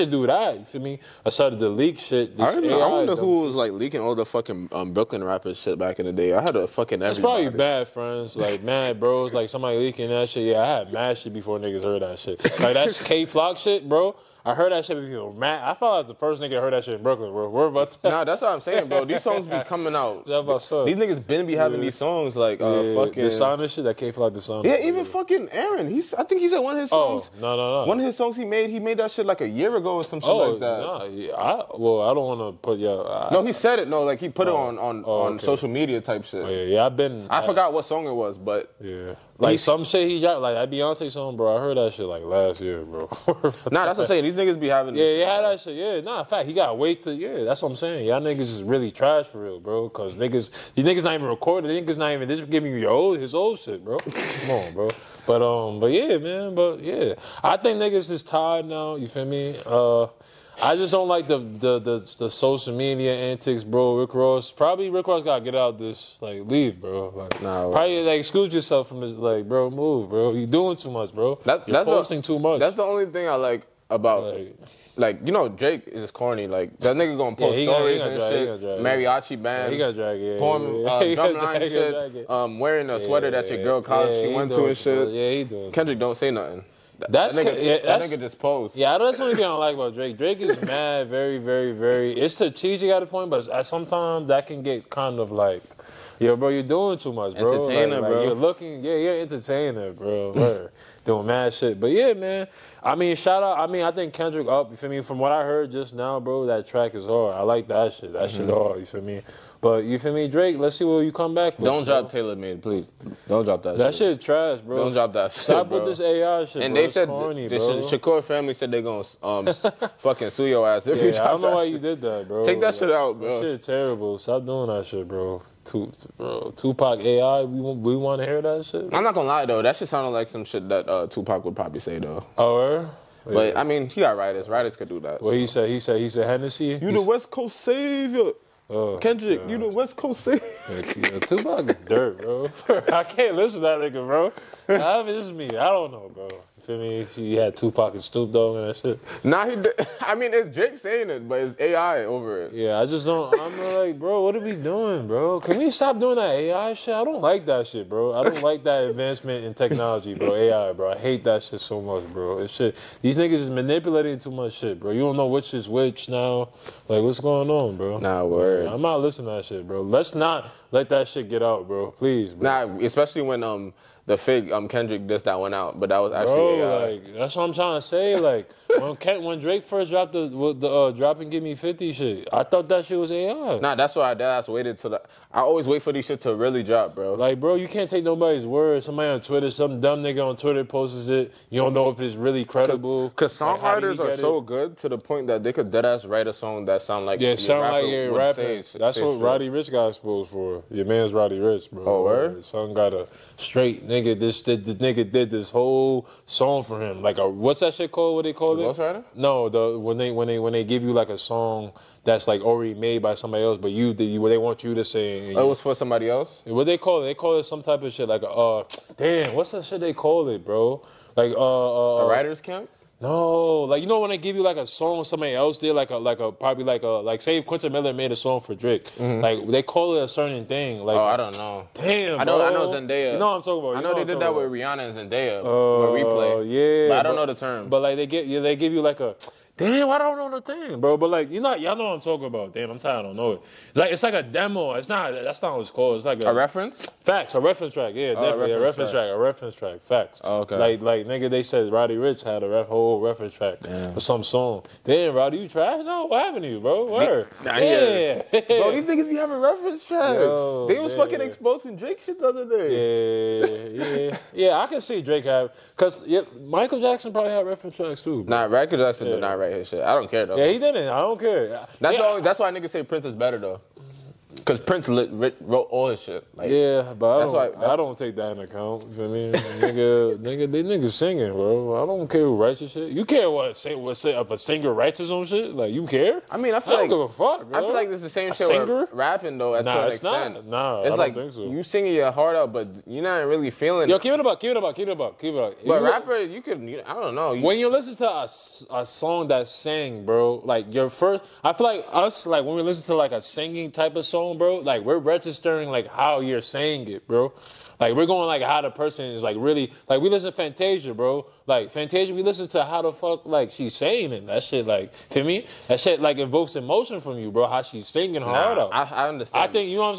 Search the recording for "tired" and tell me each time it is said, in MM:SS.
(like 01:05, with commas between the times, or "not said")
00:58, 04:02.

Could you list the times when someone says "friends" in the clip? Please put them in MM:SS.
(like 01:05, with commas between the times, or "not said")
00:07.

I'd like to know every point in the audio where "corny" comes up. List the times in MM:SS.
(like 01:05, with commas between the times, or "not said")
01:16, 01:57.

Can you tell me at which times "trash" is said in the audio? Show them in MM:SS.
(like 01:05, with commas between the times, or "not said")
00:48, 01:54, 04:15.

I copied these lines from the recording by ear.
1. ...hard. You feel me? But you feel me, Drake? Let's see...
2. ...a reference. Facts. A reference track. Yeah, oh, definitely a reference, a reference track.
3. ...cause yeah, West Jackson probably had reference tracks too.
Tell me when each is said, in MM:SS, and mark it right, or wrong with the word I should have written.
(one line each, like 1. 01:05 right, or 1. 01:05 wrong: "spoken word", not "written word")
1. 01:48 right
2. 04:06 right
3. 04:25 wrong: "Michael", not "West".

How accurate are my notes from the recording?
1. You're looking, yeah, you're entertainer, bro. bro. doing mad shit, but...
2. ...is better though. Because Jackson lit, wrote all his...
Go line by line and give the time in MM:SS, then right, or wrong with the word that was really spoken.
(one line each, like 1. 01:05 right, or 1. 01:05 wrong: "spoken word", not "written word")
1. 01:38 right
2. 04:33 wrong: "Prince", not "Jackson".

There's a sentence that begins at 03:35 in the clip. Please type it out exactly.
Oh, it was for somebody else.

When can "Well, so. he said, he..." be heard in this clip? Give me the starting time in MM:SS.
02:15.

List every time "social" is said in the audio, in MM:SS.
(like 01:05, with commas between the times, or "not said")
00:35, 01:02.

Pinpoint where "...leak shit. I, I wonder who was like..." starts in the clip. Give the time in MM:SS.
00:01.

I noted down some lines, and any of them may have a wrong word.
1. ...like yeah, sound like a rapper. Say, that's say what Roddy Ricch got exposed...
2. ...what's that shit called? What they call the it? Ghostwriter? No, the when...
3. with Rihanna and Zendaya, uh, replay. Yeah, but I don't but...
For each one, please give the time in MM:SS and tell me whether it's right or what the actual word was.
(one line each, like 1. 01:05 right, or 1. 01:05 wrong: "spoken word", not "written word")
1. 03:17 right
2. 03:27 right
3. 03:54 right.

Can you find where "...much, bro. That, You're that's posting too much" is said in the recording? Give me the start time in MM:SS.
01:10.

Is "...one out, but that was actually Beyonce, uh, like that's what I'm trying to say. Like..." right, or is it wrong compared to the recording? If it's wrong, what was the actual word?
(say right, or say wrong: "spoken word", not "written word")
wrong: "Bro", not "Beyonce".